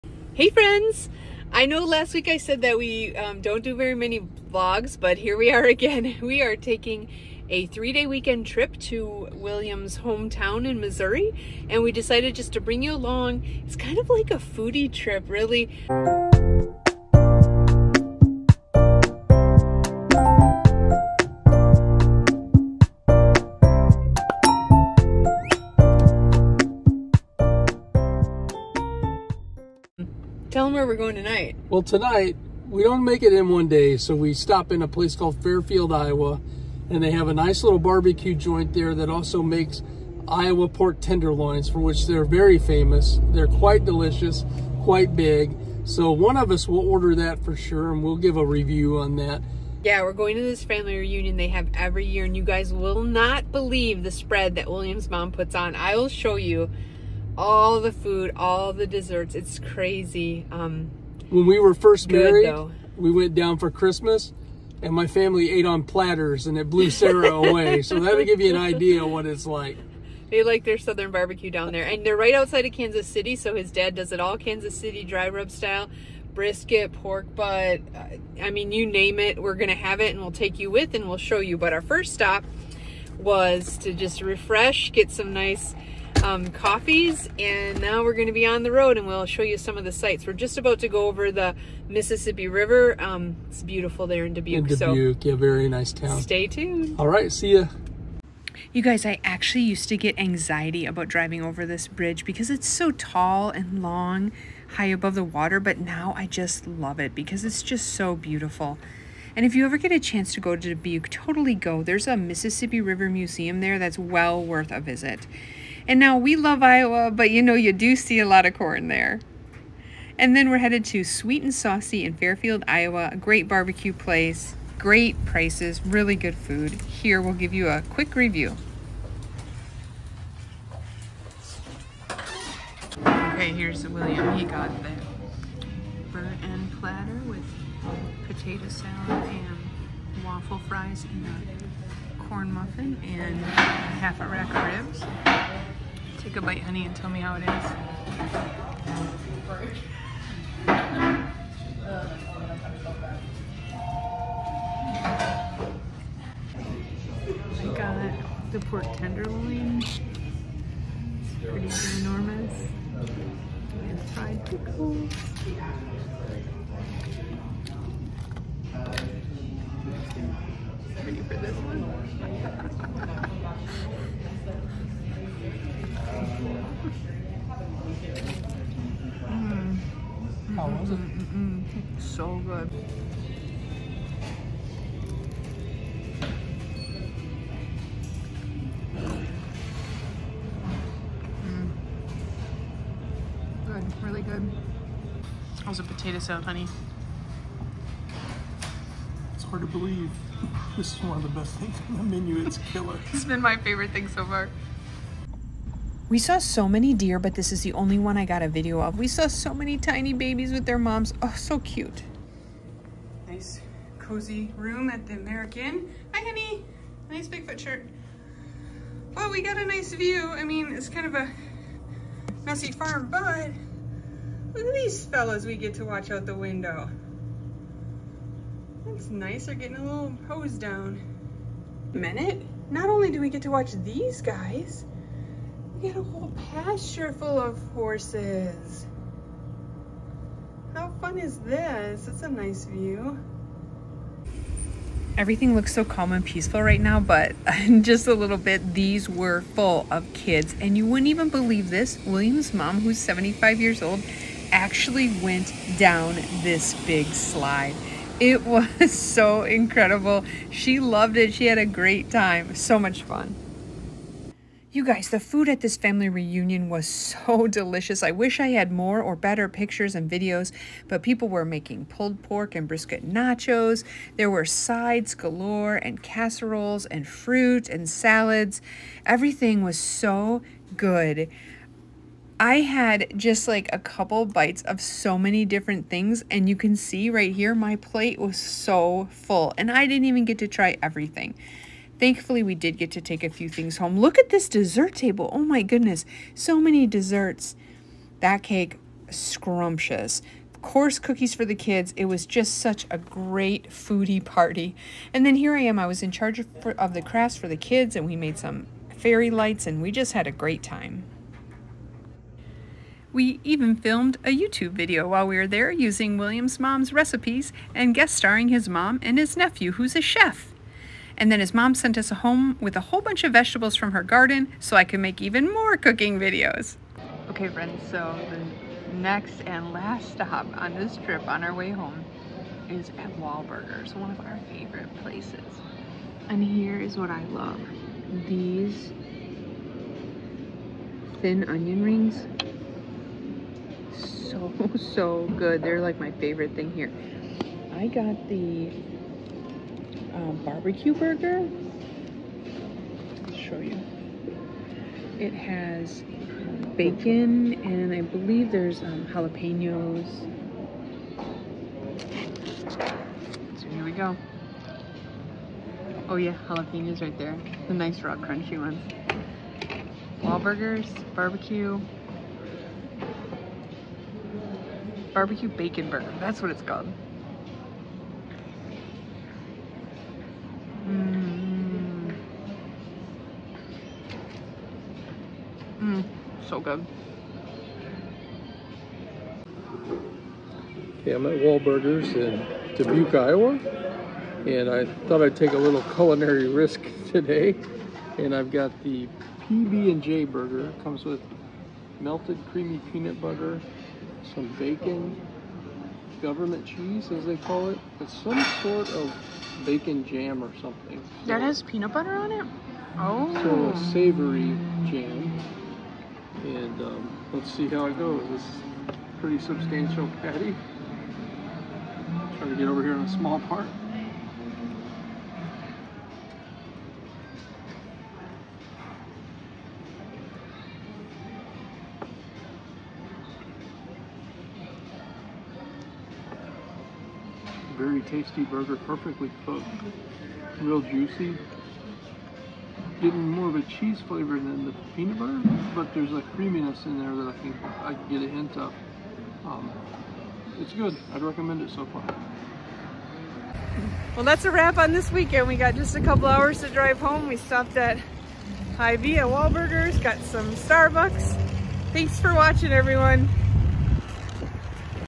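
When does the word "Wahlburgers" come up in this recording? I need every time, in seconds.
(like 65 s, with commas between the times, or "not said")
333 s, 370 s, 391 s, 459 s.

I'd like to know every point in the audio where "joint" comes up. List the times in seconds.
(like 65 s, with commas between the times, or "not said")
38 s.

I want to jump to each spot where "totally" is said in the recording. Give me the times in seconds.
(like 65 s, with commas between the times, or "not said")
111 s.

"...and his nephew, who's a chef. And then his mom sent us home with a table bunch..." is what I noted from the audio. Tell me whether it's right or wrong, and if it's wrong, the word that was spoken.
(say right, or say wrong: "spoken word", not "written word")
wrong: "whole", not "table".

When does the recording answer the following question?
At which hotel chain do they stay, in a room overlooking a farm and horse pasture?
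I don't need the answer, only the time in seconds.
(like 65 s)
215 s.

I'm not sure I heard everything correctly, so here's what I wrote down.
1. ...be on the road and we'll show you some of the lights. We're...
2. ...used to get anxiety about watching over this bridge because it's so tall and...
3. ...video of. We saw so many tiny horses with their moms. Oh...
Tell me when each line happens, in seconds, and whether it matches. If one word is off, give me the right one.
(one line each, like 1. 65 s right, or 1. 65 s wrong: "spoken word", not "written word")
1. 88 s wrong: "sights", not "lights"
2. 99 s wrong: "driving", not "watching"
3. 208 s wrong: "babies", not "horses".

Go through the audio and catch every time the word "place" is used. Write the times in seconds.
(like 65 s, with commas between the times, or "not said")
34 s, 123 s, 335 s.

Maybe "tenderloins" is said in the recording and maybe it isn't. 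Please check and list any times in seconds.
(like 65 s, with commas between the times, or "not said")
40 s, 158 s.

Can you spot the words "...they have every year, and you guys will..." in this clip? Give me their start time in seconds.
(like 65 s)
51 s.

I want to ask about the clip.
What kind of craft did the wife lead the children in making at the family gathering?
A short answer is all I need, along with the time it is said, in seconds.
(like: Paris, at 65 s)
Fairy lights, at 308 s.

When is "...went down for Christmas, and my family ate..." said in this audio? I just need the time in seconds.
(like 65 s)
63 s.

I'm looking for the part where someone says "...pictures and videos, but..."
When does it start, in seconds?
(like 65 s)
269 s.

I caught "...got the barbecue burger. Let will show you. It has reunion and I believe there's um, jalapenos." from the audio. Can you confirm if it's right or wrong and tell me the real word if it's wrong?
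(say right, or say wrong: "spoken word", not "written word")
wrong: "bacon", not "reunion".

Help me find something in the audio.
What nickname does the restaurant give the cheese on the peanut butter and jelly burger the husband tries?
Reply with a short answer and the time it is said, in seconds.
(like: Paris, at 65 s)
Government cheese, at 406 s.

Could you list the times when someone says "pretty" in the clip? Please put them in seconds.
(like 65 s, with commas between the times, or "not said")
161 s, 419 s.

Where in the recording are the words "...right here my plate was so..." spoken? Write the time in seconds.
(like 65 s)
287 s.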